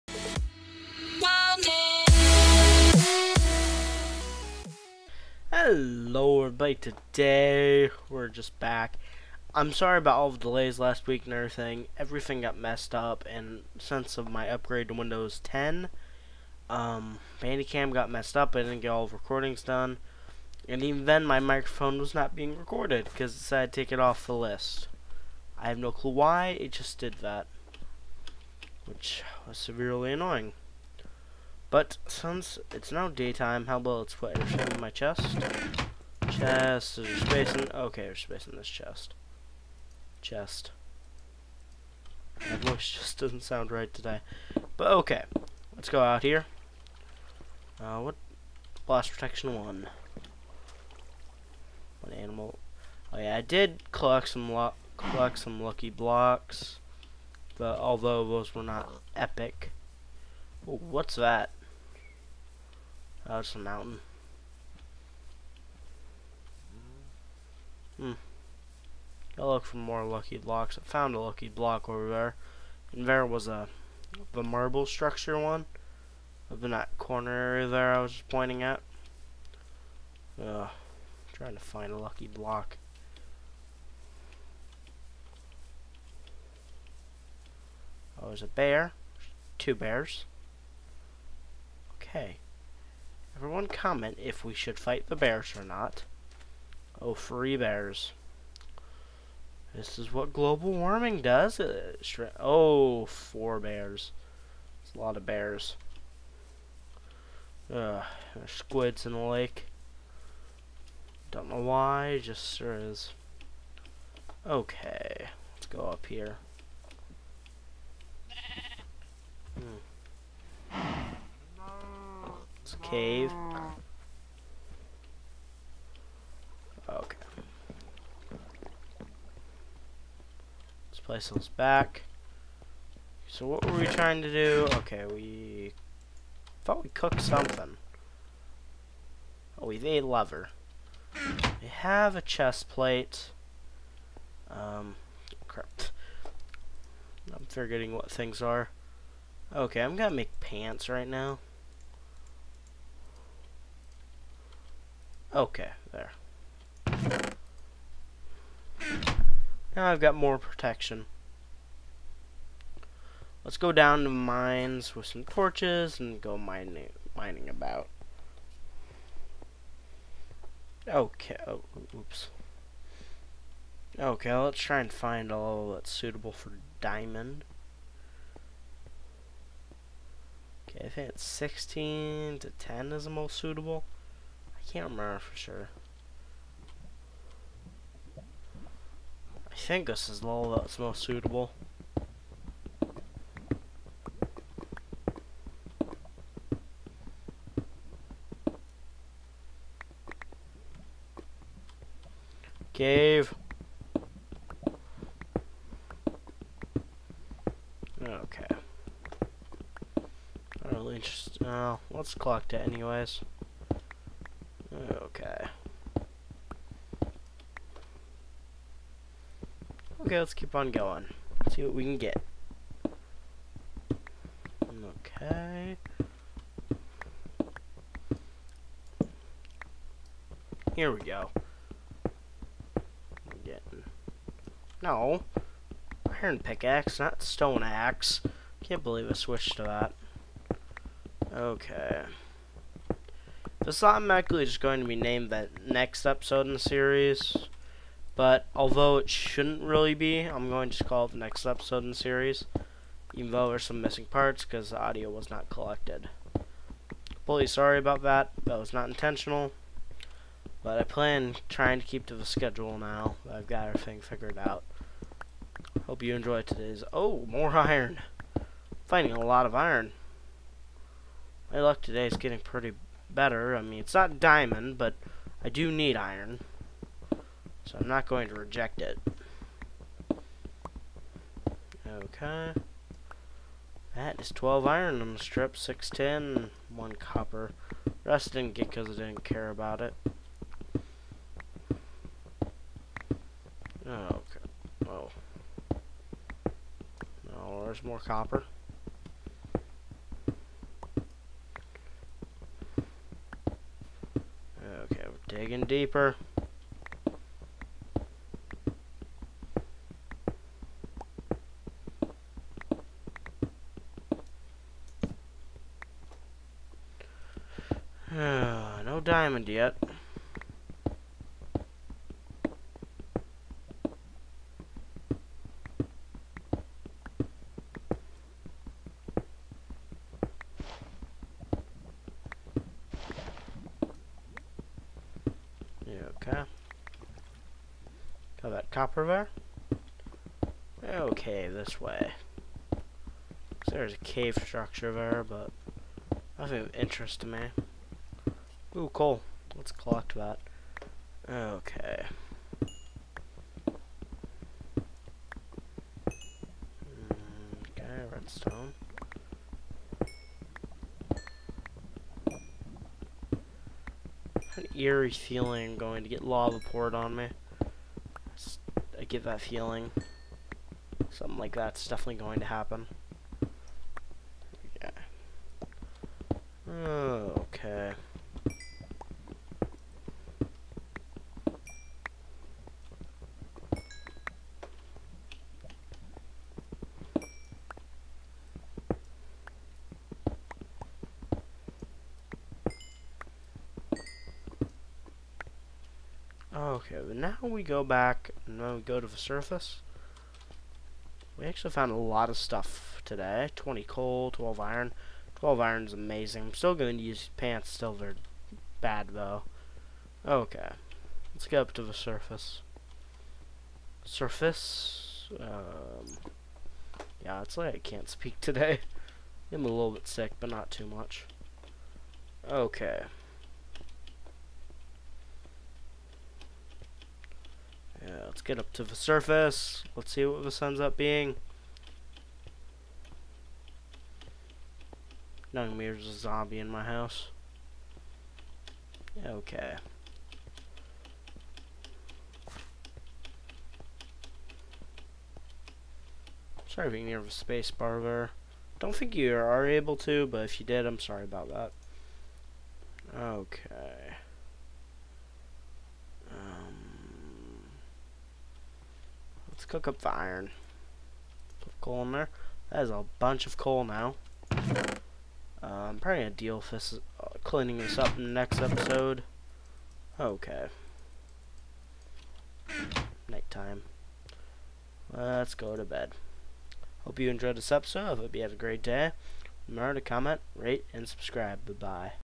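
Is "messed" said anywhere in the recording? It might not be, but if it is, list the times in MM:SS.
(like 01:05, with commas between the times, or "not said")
00:12, 00:18.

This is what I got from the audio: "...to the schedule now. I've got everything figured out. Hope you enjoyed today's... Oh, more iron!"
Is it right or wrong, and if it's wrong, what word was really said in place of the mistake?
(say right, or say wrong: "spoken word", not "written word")
right.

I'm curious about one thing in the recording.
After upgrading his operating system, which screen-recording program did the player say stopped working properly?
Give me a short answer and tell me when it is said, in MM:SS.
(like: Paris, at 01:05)
Bandicam, at 00:17.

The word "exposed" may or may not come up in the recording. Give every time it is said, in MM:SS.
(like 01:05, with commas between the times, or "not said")
not said.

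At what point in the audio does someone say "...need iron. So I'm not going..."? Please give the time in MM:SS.
04:35.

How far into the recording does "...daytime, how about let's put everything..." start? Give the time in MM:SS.
00:33.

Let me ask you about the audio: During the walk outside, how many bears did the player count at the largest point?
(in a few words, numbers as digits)
4.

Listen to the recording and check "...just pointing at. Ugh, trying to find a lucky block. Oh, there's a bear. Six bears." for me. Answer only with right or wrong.
wrong.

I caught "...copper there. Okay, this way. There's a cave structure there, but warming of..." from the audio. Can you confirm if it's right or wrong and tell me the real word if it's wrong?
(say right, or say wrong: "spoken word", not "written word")
wrong: "nothing", not "warming".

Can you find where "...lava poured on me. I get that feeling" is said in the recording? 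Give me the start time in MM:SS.
06:06.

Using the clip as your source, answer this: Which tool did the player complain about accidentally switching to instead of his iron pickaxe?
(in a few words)
Stone axe.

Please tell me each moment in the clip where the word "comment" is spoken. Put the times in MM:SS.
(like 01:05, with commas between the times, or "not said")
01:33, 08:00.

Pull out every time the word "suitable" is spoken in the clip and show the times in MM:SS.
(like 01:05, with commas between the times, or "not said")
02:55, 03:03, 03:11.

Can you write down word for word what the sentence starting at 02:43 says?
Let's go down to mines with some torches and go mining mining about.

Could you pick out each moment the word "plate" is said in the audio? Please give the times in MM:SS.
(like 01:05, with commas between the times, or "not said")
02:22.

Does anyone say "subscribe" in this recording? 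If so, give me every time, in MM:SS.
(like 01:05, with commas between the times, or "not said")
08:01.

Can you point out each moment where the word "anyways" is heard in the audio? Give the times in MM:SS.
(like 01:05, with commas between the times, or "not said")
03:32.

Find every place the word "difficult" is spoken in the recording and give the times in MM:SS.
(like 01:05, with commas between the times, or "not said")
not said.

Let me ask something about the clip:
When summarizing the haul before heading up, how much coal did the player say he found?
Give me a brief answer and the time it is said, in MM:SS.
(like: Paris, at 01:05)
20, at 06:43.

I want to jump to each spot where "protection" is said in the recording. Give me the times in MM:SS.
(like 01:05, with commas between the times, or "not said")
00:49, 02:40.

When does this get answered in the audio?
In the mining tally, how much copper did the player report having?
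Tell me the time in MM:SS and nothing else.
04:46.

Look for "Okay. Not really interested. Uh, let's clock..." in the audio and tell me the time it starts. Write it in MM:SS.
03:28.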